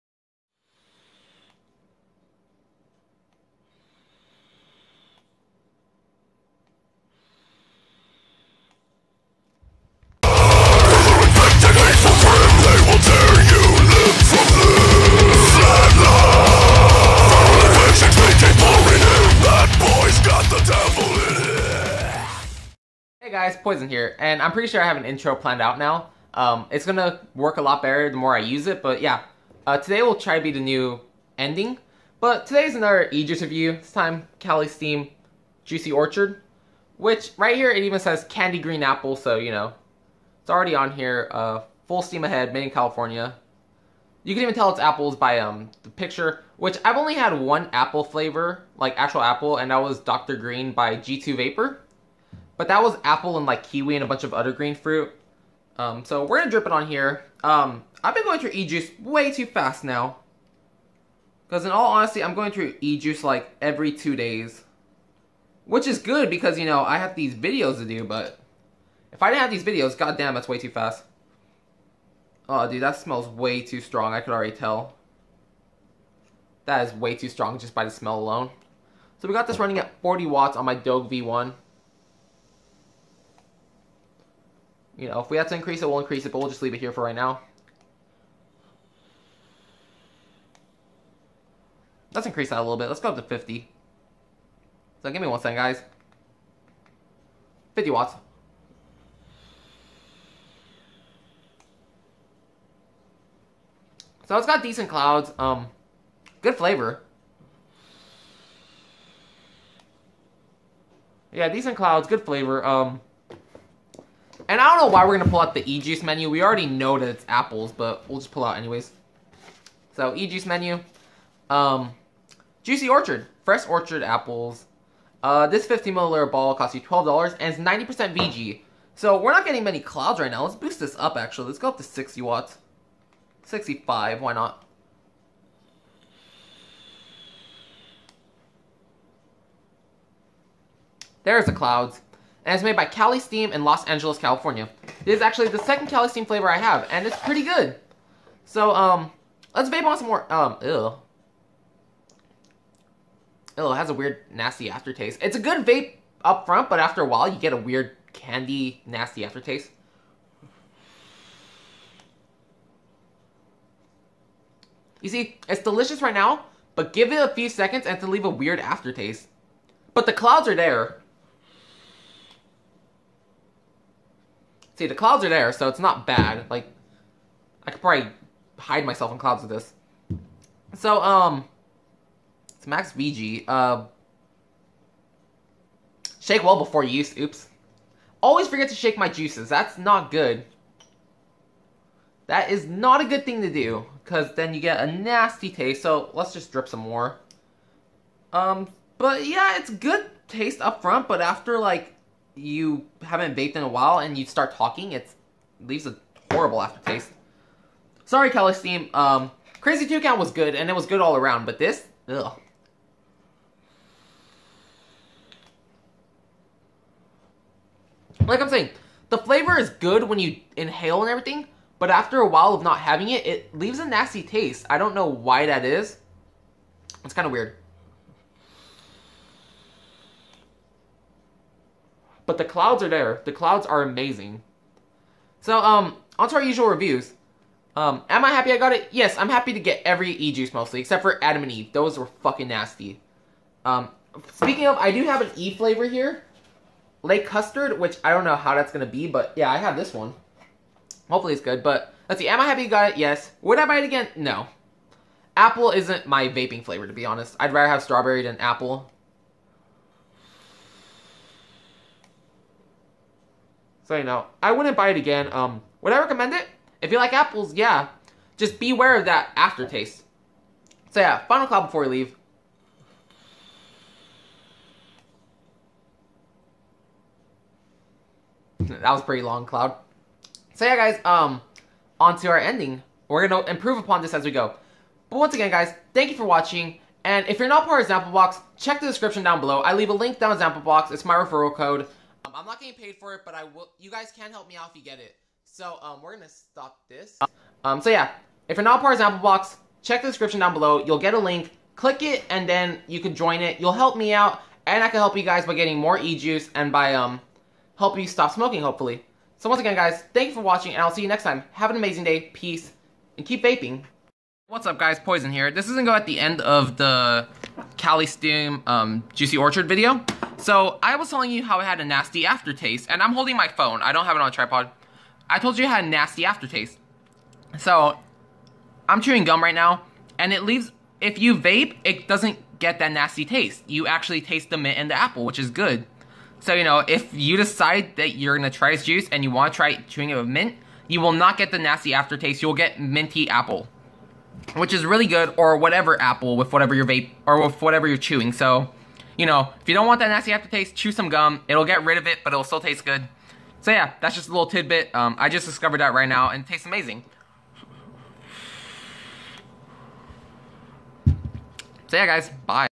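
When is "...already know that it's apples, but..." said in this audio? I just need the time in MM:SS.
01:56.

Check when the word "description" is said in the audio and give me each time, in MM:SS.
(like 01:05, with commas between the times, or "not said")
04:48, 05:00.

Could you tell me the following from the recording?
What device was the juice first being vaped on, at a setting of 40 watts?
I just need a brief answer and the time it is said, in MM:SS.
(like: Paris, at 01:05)
Dog V1, at 01:20.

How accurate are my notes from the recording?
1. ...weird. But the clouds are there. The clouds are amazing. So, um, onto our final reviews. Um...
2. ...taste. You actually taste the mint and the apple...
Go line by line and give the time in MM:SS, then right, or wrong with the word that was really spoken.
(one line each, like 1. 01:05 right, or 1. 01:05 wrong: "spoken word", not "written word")
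1. 03:47 wrong: "usual", not "final"
2. 05:33 right.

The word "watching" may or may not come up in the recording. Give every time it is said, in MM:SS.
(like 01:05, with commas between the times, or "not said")
04:46, 05:10.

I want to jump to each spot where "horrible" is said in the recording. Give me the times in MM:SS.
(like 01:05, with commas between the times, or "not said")
03:26.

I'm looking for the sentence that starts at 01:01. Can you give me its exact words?
Because in all honesty, I'm going through e-juice like every two days.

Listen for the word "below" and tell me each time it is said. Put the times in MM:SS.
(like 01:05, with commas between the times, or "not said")
04:49, 05:00.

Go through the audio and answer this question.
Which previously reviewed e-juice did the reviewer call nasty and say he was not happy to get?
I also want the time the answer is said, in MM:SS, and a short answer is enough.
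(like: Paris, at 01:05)
Adam and Eve, at 04:01.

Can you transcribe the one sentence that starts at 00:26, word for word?
Um, it's gonna work a lot better the more I use it, but yeah.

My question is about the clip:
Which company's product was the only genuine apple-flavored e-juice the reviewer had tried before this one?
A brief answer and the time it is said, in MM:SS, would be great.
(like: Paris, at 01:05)
G2 Vapor, at 00:50.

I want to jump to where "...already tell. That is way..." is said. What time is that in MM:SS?
01:14.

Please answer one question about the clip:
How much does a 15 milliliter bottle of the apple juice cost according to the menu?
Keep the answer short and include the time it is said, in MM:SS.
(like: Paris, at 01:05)
$12, at 02:06.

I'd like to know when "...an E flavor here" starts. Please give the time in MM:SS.
04:05.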